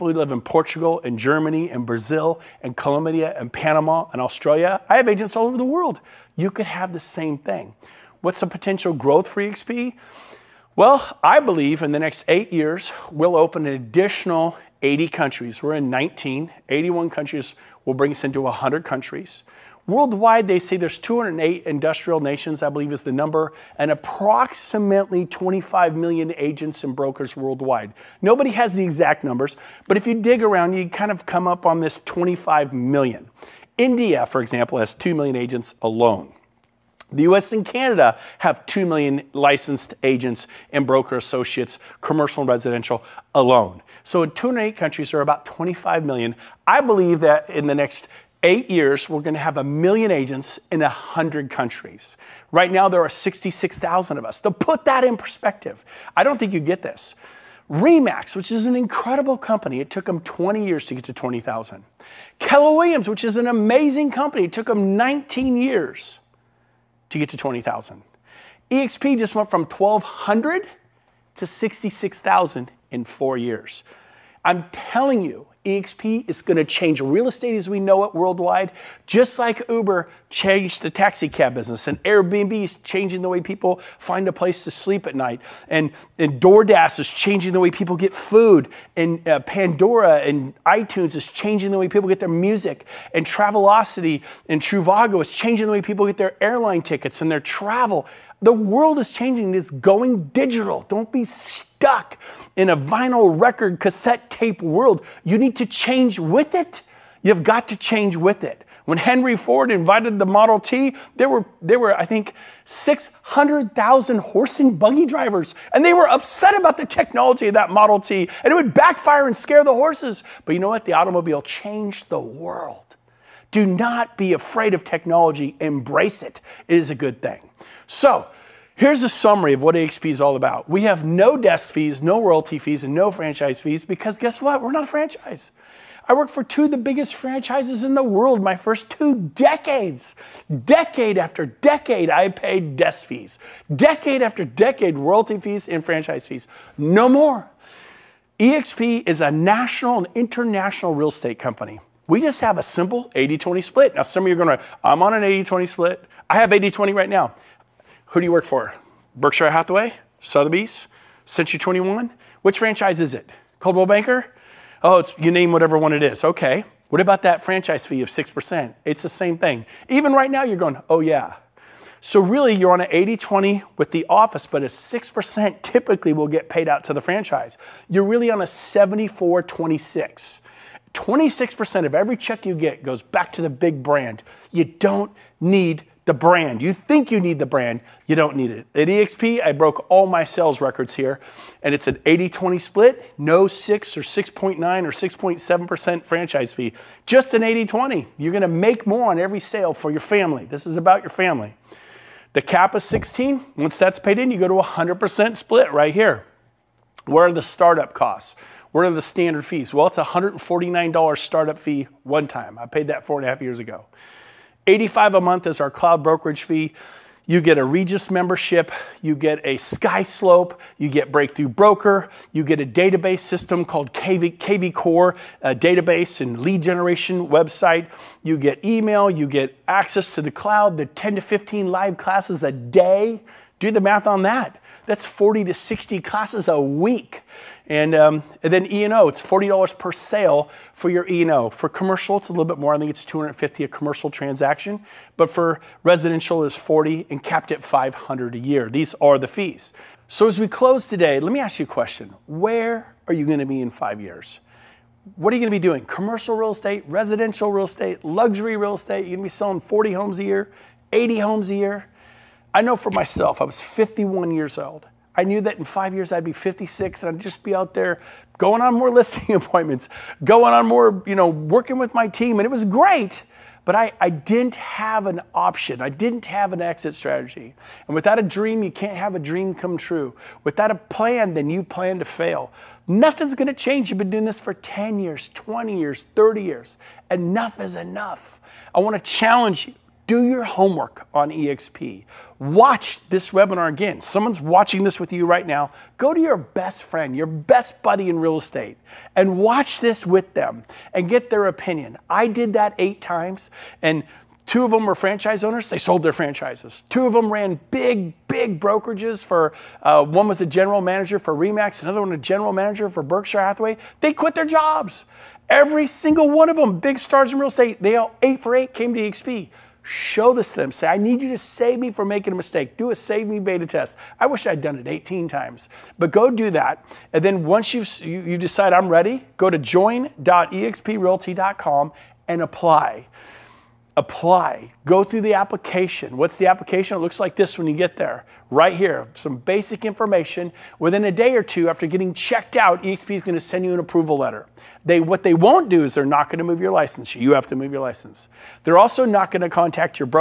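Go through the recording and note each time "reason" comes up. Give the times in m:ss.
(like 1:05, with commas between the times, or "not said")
not said.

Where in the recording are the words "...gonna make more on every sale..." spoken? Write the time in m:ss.
3:18.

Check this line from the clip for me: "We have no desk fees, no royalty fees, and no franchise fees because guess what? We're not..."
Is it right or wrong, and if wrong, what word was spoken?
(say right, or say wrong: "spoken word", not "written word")
right.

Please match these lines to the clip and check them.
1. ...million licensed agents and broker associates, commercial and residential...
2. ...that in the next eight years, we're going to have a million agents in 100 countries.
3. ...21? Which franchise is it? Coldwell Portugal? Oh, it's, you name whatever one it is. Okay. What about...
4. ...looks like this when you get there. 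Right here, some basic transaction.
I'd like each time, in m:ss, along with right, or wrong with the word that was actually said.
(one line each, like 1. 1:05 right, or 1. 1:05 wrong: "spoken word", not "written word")
1. 0:38 right
2. 0:47 right
3. 2:41 wrong: "Banker", not "Portugal"
4. 5:36 wrong: "information", not "transaction".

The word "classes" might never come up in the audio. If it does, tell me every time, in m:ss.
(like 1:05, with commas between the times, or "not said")
3:51, 3:55.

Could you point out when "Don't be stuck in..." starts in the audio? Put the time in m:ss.
1:40.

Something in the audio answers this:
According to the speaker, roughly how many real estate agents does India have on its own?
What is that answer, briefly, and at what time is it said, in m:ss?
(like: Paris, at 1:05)
2 million, at 0:34.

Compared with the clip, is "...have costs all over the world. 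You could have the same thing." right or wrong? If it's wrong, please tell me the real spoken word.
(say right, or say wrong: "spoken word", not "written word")
wrong: "agents", not "costs".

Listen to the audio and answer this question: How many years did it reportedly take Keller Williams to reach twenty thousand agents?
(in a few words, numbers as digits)
19 years.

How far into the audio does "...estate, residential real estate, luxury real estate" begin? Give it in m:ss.
4:16.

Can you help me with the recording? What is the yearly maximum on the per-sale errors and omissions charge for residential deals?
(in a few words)
500.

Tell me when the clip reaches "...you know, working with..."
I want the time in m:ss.
4:31.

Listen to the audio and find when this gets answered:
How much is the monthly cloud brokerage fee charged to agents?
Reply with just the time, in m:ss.
3:34.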